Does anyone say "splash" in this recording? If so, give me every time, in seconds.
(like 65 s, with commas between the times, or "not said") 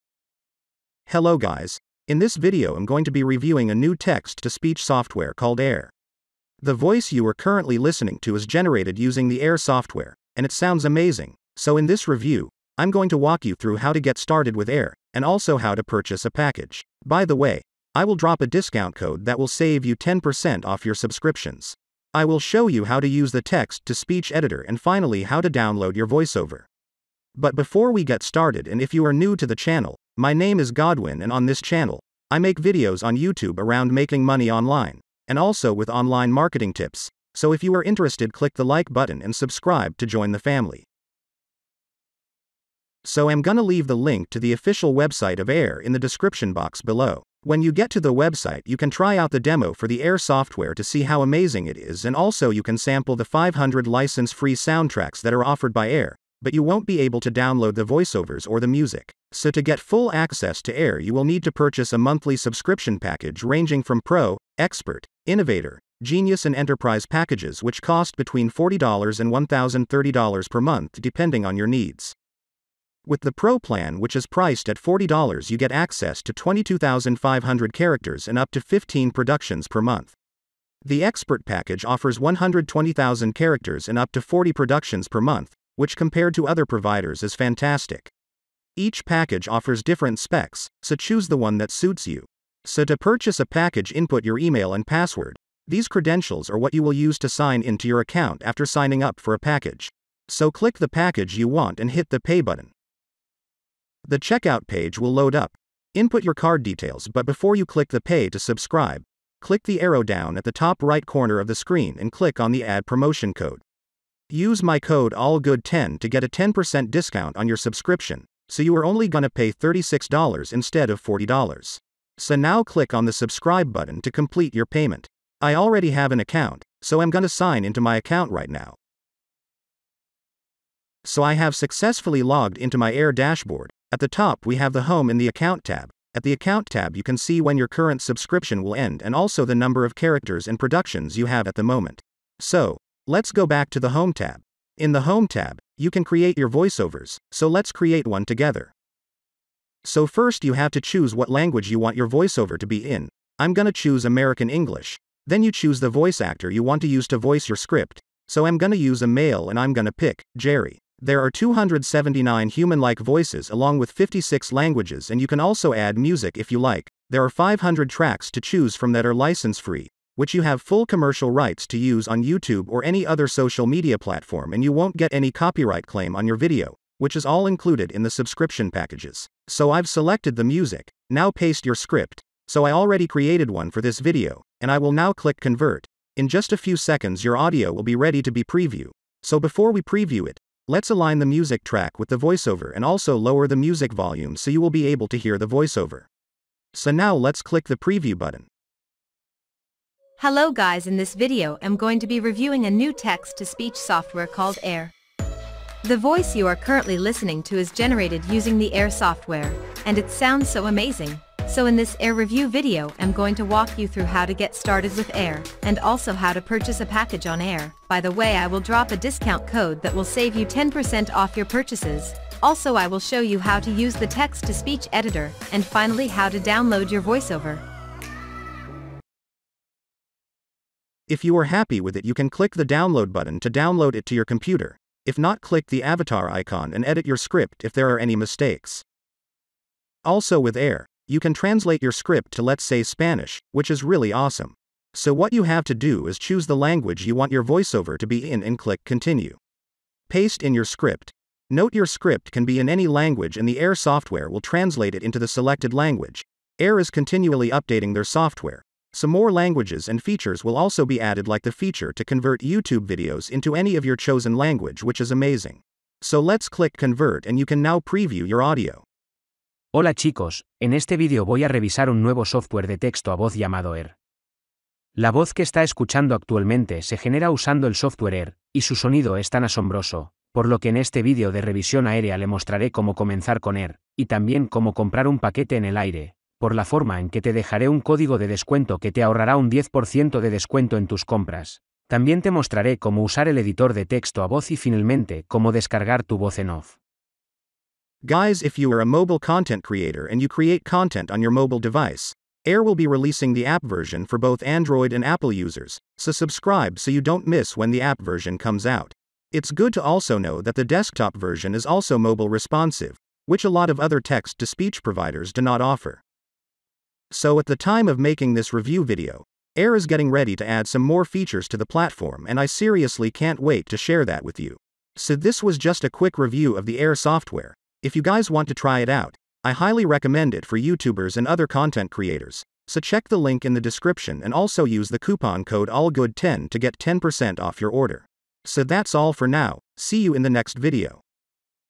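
not said.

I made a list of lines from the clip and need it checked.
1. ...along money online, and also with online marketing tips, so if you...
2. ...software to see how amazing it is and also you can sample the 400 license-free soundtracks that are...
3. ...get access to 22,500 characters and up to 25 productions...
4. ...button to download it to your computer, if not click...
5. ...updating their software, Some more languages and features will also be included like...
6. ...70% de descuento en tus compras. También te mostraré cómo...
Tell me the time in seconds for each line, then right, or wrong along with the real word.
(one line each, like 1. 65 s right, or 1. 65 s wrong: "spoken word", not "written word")
1. 33 s wrong: "making", not "along"
2. 50 s wrong: "500", not "400"
3. 75 s wrong: "15", not "25"
4. 233 s right
5. 257 s wrong: "added", not "included"
6. 289 s wrong: "10", not "70".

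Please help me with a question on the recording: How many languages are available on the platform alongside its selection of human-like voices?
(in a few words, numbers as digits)
56.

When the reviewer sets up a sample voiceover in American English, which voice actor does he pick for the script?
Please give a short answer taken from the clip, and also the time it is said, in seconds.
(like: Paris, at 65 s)
Jerry, at 160 s.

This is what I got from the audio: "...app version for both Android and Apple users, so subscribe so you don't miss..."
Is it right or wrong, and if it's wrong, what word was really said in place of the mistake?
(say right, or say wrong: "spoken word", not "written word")
right.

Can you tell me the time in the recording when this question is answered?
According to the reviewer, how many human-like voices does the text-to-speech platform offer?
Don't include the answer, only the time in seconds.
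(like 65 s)
161 s.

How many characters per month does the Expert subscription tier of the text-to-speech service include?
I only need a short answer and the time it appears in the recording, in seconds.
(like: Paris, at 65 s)
120,000, at 82 s.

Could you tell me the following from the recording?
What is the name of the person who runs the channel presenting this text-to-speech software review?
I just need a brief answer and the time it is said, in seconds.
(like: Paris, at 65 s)
Godwin, at 30 s.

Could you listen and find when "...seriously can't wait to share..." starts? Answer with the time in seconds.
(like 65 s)
322 s.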